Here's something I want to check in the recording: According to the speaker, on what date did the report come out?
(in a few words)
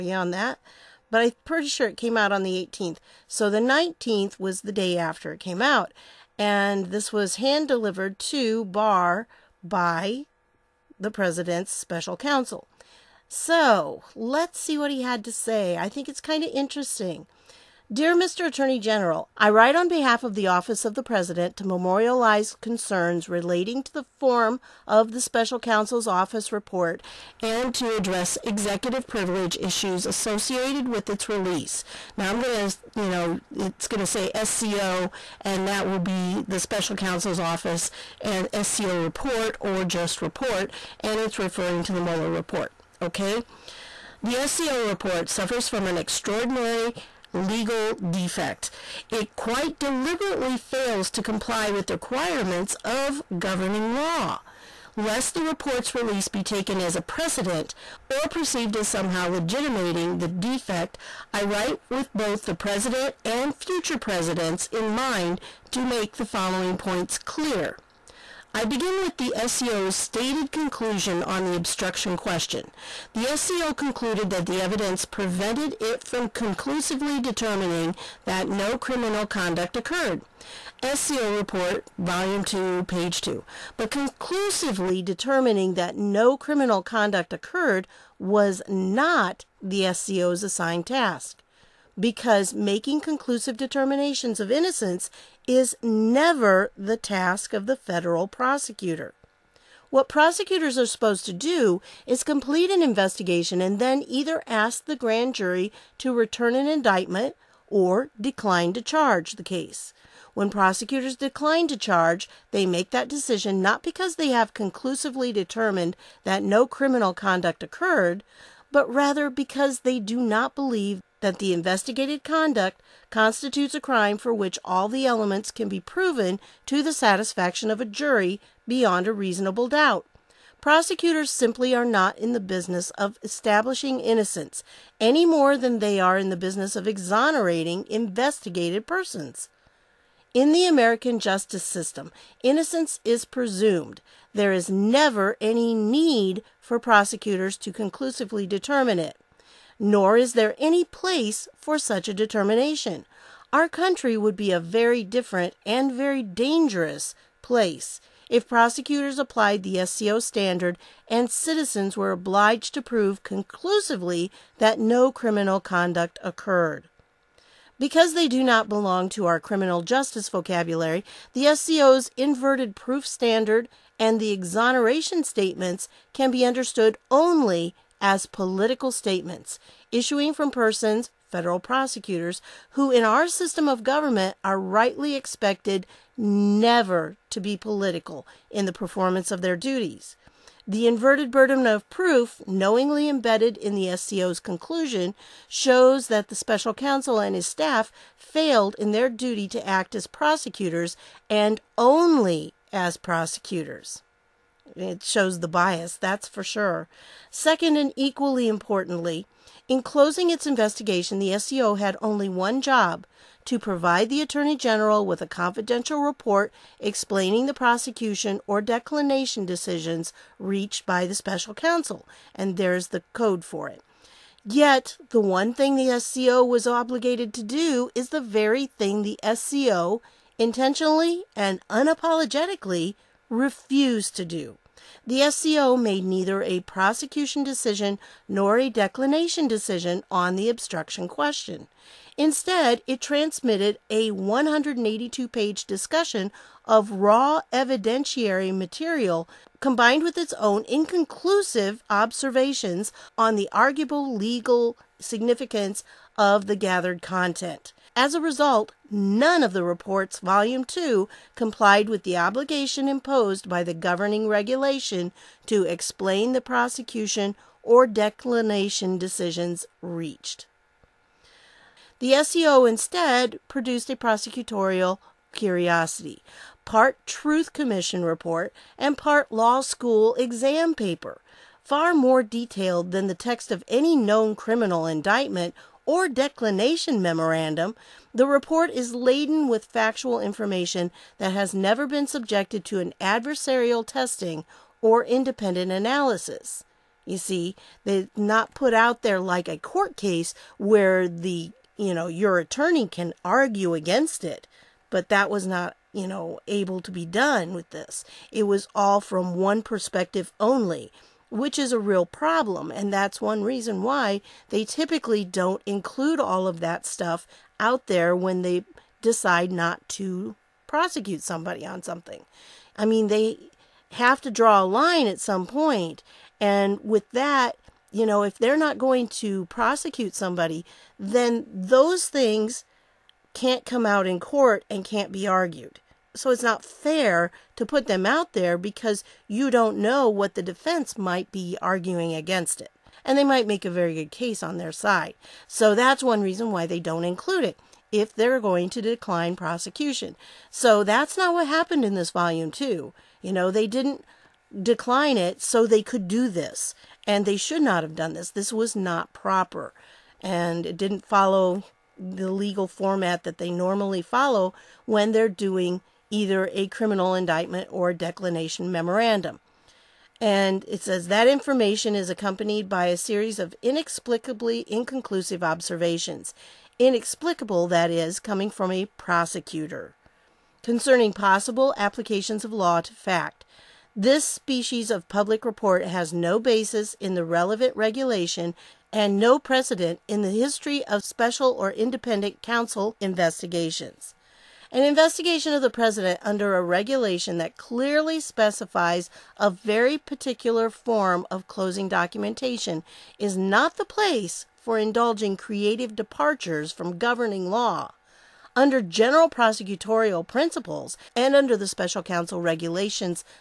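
the 18th.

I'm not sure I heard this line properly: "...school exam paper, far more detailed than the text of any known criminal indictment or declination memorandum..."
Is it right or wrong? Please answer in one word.
right.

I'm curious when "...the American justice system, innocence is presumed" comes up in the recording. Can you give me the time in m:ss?
2:20.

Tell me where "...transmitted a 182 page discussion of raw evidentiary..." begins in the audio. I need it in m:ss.
4:03.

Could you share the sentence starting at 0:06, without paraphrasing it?
And this was hand delivered to Barr by the president's special counsel.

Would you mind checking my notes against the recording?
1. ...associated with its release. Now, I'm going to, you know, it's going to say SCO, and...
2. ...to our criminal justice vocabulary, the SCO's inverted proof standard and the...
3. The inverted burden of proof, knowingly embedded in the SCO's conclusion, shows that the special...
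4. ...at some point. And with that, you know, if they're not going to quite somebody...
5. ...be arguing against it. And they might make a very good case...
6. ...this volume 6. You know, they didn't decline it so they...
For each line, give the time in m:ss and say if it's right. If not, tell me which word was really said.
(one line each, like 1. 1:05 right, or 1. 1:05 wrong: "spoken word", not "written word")
1. 0:30 right
2. 2:49 right
3. 3:10 right
4. 5:25 wrong: "prosecute", not "quite"
5. 5:41 right
6. 5:51 wrong: "2", not "6".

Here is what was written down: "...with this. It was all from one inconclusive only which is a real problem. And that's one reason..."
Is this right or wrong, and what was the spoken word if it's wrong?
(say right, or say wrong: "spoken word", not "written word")
wrong: "perspective", not "inconclusive".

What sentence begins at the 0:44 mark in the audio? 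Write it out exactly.
The SCO report suffers from an extraordinary legal defect.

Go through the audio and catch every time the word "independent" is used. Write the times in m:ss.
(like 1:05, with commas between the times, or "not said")
4:55, 6:31.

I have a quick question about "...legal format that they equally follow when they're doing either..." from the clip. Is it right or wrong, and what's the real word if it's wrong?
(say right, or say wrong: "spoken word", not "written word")
wrong: "normally", not "equally".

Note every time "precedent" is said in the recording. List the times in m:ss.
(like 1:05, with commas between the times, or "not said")
0:57, 6:29.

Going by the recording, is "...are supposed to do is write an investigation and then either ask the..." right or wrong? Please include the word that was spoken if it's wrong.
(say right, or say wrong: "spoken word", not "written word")
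wrong: "complete", not "write".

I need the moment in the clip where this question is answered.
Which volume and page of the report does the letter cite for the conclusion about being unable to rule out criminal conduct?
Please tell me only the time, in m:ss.
1:21.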